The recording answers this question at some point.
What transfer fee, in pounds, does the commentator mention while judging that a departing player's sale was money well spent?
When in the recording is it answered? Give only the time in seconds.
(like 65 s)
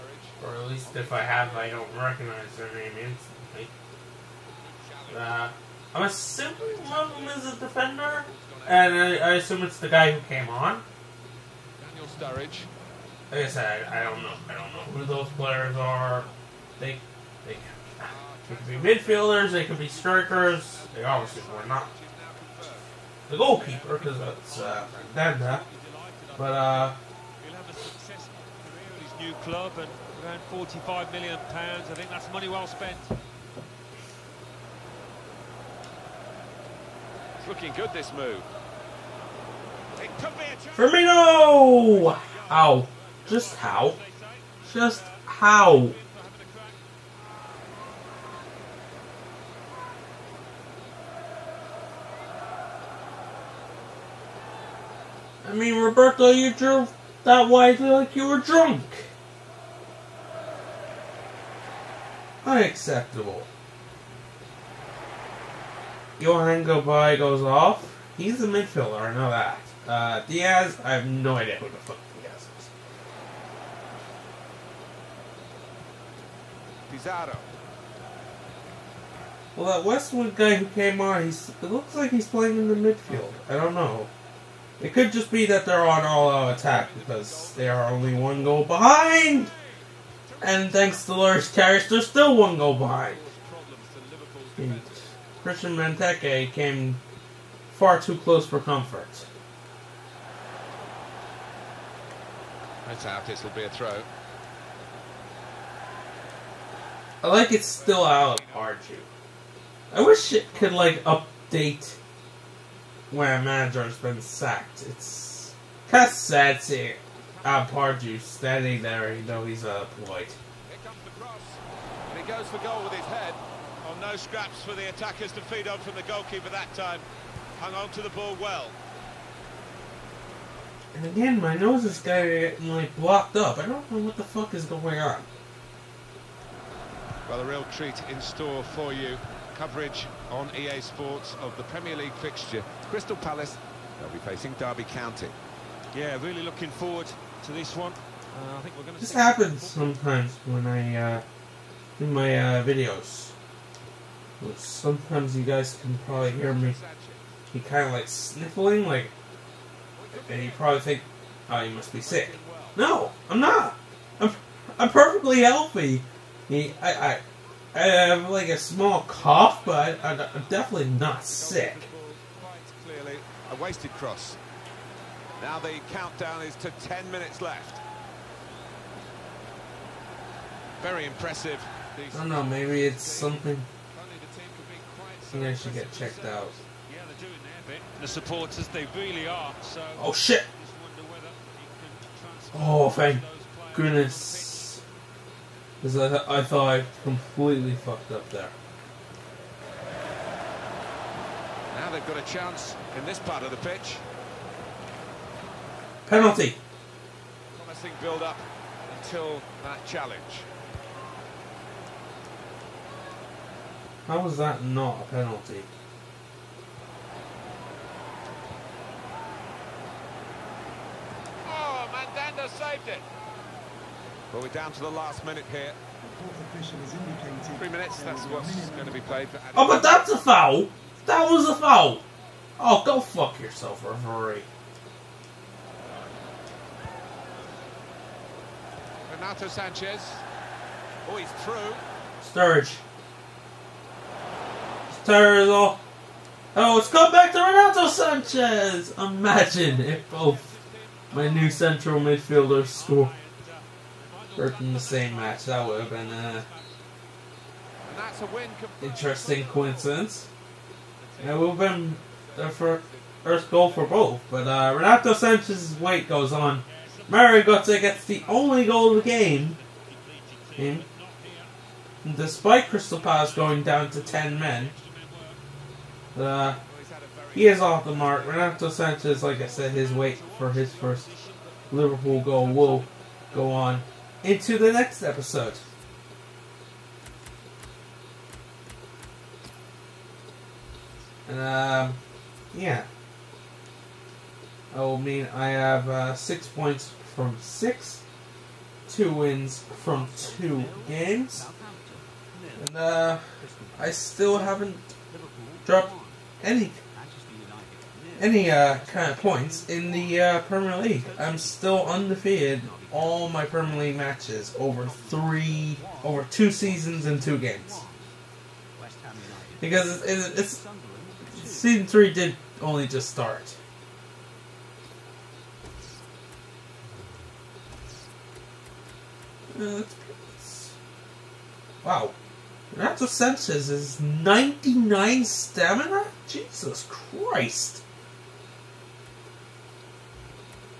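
30 s.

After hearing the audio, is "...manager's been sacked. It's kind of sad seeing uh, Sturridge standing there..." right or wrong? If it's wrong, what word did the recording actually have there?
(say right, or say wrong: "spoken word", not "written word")
wrong: "Pardew", not "Sturridge".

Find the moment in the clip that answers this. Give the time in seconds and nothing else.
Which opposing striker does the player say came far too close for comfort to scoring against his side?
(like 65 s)
95 s.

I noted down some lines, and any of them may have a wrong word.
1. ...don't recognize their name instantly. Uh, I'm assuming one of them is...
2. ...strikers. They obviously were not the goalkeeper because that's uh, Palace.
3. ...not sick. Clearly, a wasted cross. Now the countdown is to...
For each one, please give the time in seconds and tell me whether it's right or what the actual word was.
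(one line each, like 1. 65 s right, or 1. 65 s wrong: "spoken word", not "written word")
1. 1 s right
2. 19 s wrong: "Fernanda", not "Palace"
3. 170 s right.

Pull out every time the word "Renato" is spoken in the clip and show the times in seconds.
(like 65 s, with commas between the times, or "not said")
239 s, 247 s, 264 s, 278 s.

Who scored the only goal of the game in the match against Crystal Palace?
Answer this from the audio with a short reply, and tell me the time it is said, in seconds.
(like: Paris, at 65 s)
Mario Götze, at 267 s.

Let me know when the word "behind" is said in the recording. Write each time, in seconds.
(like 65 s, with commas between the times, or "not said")
88 s, 92 s.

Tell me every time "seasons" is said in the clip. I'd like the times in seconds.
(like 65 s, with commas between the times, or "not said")
316 s, 321 s.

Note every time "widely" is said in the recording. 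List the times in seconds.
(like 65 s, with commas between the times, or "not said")
57 s.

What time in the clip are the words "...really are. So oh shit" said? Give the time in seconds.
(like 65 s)
188 s.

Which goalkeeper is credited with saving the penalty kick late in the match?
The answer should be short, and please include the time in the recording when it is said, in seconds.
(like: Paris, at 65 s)
Mandanda, at 221 s.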